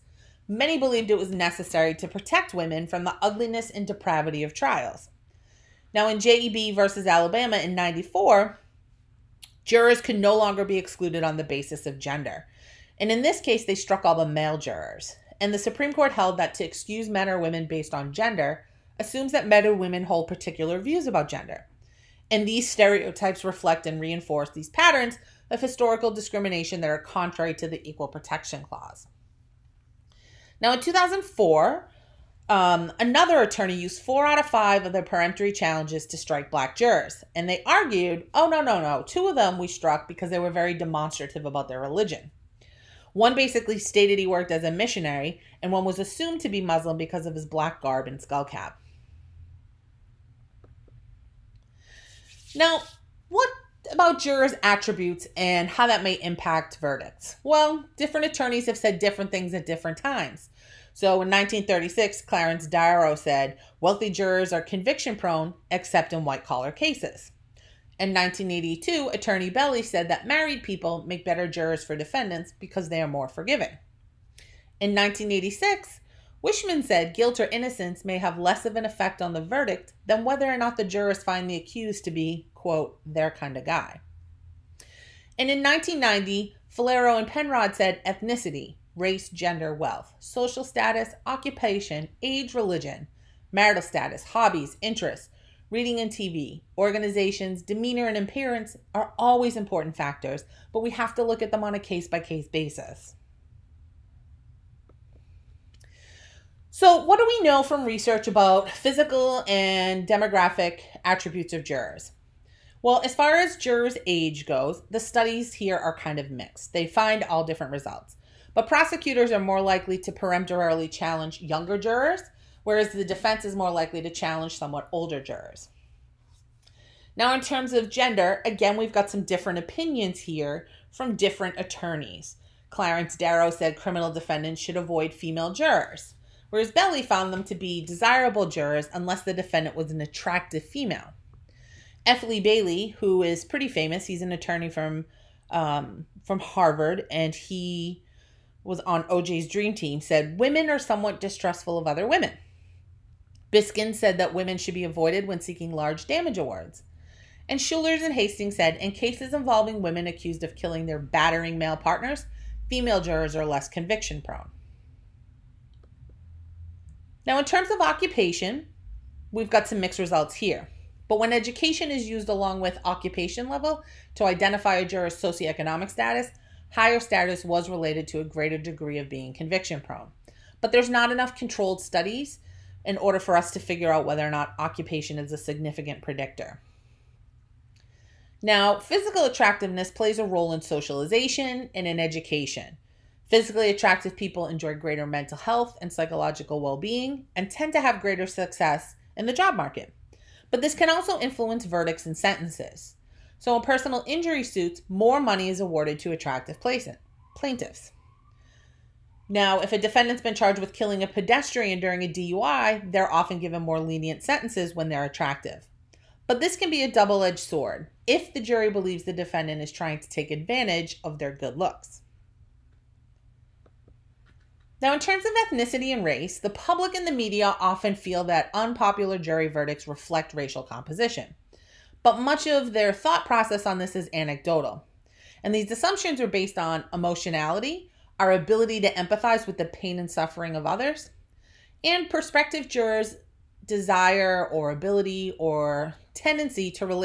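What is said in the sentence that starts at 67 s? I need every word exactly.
In 1982, Attorney Belli said that married people make better jurors for defendants because they are more forgiving.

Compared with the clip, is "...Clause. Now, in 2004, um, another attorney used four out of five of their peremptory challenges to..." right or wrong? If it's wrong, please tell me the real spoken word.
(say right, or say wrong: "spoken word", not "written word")
right.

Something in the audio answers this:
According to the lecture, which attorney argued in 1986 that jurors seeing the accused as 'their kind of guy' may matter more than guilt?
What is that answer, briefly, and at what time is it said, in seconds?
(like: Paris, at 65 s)
Wishman, at 76 s.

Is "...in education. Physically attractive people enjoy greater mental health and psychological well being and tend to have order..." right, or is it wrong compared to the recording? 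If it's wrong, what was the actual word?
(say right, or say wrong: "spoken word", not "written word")
wrong: "greater", not "order".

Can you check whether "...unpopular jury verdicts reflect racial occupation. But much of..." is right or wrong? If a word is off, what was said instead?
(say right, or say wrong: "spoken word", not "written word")
wrong: "composition", not "occupation".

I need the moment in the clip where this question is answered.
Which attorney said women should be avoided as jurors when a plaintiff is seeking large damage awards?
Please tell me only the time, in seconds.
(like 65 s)
153 s.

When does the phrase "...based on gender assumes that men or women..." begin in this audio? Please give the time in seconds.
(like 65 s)
17 s.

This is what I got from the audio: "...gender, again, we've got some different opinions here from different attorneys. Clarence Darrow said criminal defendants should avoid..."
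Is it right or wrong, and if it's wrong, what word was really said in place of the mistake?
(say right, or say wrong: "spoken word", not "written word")
right.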